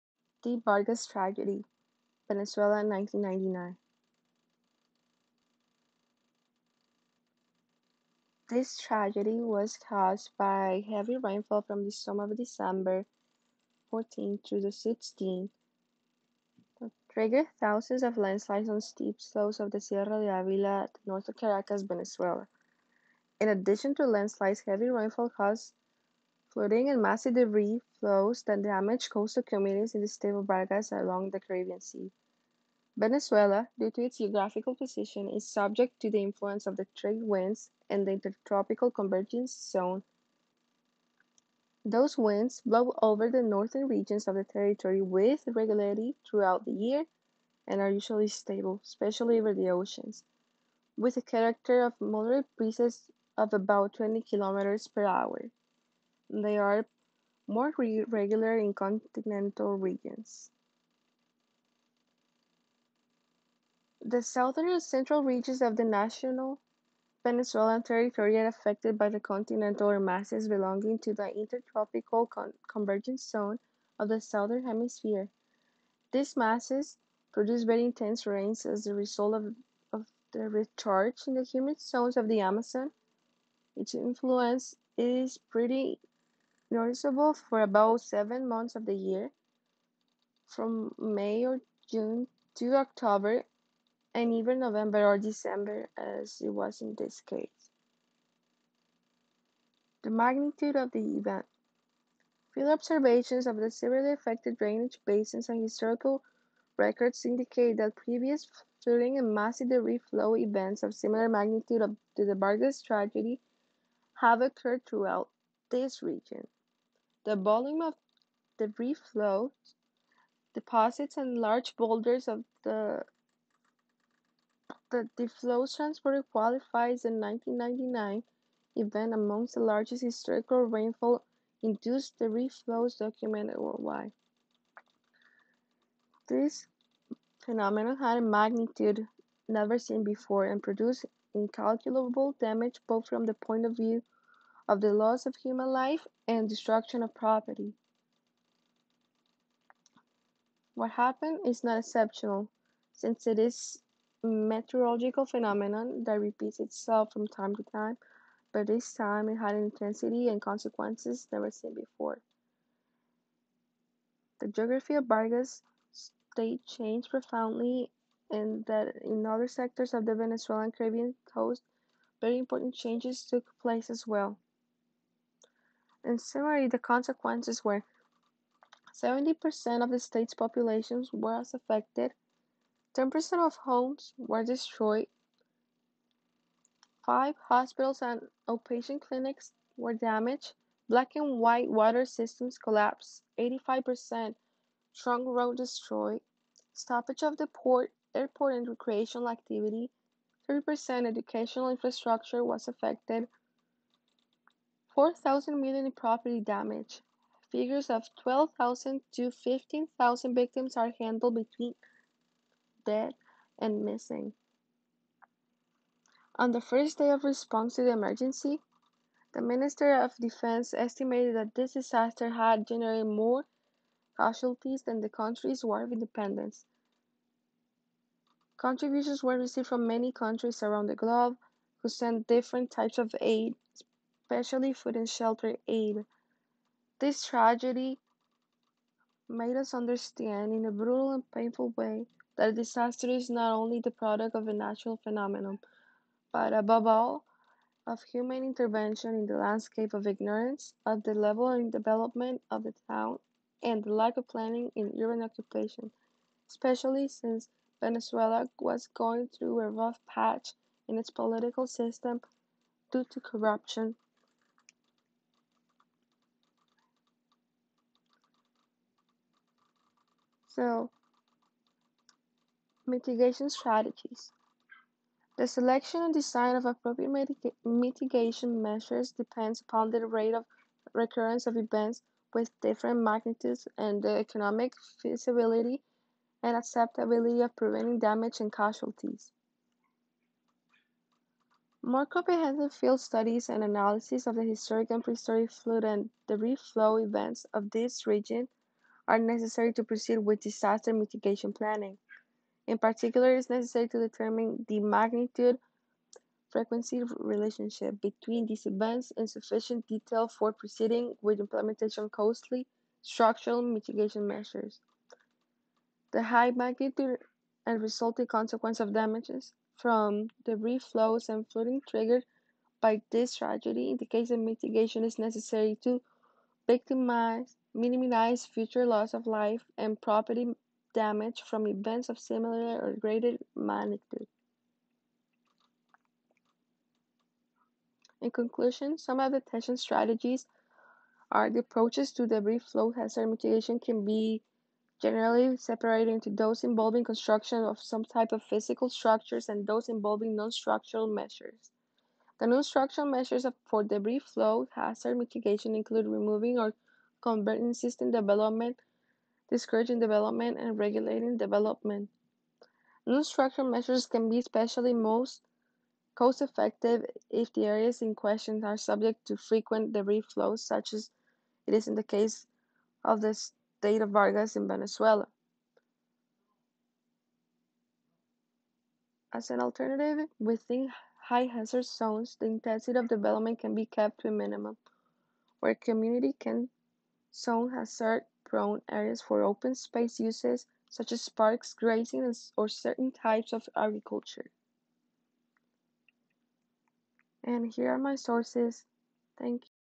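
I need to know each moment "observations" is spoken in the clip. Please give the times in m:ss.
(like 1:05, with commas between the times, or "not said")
1:42.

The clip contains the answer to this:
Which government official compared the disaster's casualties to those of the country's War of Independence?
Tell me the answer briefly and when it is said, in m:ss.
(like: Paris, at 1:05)
Minister of Defense, at 3:39.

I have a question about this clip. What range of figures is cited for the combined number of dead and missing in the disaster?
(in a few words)
12,000 to 15,000.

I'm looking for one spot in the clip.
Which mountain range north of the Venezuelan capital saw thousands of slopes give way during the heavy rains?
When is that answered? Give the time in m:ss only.
0:19.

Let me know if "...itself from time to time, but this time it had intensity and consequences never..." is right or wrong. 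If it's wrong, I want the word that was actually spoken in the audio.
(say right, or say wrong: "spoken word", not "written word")
right.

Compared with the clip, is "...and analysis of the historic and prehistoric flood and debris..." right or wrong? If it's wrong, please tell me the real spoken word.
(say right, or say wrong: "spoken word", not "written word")
right.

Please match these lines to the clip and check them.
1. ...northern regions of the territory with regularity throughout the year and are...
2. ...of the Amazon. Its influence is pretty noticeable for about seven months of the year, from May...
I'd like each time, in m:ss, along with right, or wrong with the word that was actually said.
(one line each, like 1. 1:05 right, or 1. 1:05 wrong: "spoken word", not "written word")
1. 0:43 right
2. 1:22 right.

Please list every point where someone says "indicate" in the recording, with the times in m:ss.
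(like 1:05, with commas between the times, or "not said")
1:47, 5:23.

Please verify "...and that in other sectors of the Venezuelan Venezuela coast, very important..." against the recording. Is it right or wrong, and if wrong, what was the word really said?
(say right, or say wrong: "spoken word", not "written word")
wrong: "Caribbean", not "Venezuela".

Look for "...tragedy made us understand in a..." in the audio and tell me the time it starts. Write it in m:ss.
3:57.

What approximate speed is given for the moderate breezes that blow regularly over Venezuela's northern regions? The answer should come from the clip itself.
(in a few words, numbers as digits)
20 kilometers per hour.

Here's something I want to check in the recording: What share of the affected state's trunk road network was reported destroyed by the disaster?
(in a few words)
85%.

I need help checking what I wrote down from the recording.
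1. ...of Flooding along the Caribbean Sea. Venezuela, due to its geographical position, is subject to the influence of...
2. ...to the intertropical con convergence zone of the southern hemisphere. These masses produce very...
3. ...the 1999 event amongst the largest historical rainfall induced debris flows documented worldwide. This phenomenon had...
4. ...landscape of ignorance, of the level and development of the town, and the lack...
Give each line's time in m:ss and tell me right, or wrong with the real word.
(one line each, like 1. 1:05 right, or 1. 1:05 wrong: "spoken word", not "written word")
1. 0:30 wrong: "Vargas", not "Flooding"
2. 1:10 right
3. 2:07 right
4. 4:09 right.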